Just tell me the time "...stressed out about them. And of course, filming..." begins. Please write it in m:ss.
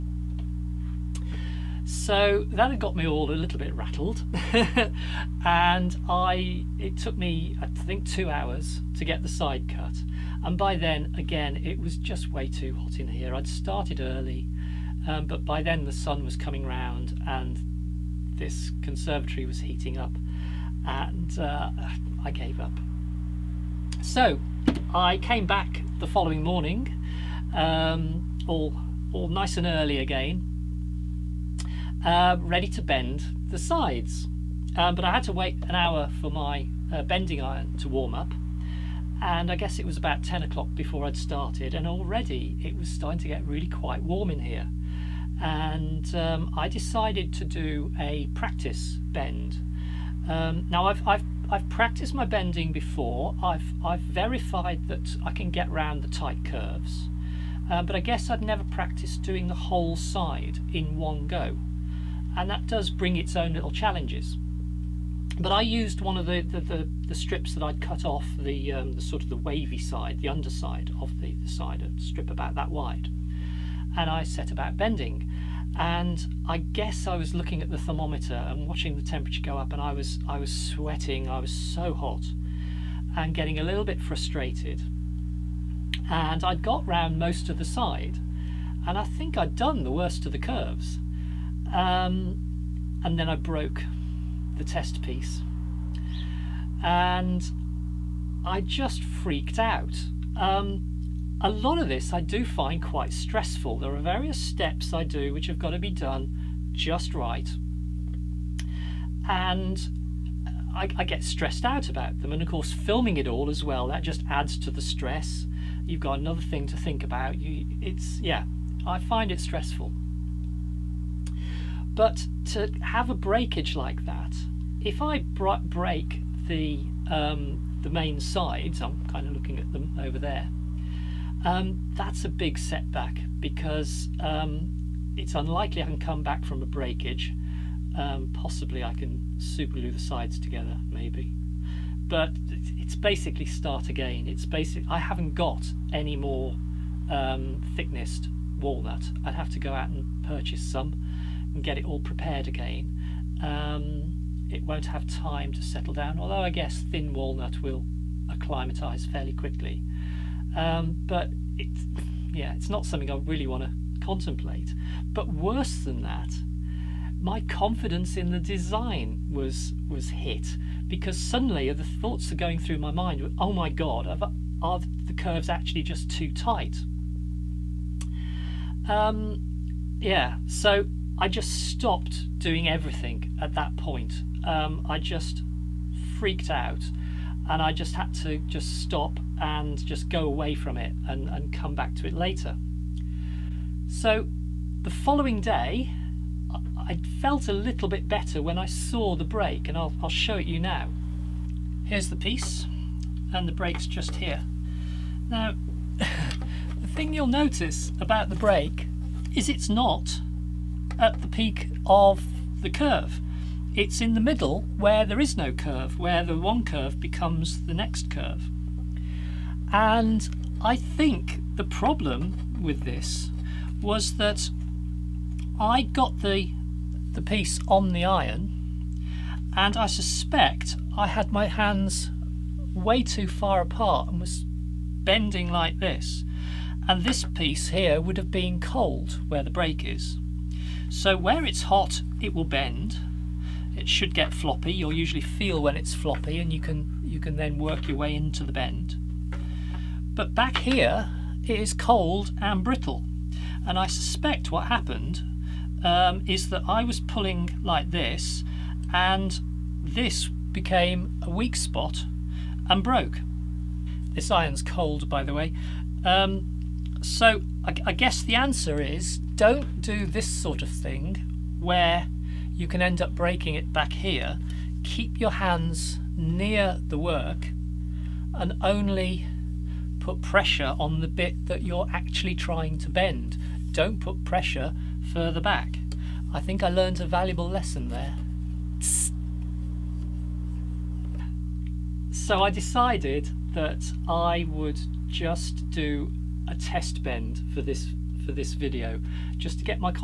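1:51.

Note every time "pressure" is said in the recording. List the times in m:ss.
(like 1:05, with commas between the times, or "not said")
4:40, 4:44.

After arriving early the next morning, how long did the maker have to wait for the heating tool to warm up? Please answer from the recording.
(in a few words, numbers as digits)
1 hour.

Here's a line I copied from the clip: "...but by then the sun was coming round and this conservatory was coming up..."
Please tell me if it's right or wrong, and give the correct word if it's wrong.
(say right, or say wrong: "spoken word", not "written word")
wrong: "heating", not "coming".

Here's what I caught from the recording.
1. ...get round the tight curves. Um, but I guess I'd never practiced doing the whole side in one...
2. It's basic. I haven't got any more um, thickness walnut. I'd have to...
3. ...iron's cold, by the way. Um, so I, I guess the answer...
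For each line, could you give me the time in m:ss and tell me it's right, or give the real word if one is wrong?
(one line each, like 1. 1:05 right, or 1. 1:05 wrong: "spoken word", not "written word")
1. 0:55 right
2. 2:24 right
3. 4:24 right.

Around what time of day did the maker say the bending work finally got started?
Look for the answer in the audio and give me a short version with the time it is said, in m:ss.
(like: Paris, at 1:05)
10 o'clock, at 0:40.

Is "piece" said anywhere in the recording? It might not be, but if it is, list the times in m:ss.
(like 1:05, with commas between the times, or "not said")
1:35, 3:22, 3:47, 3:57.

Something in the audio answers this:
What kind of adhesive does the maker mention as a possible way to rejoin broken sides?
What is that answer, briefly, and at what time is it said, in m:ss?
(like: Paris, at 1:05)
super glue, at 2:19.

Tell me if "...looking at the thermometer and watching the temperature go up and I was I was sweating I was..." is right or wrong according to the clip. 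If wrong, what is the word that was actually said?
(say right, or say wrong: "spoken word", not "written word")
right.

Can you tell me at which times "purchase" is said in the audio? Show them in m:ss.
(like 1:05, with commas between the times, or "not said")
2:30.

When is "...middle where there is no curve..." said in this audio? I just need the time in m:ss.
3:34.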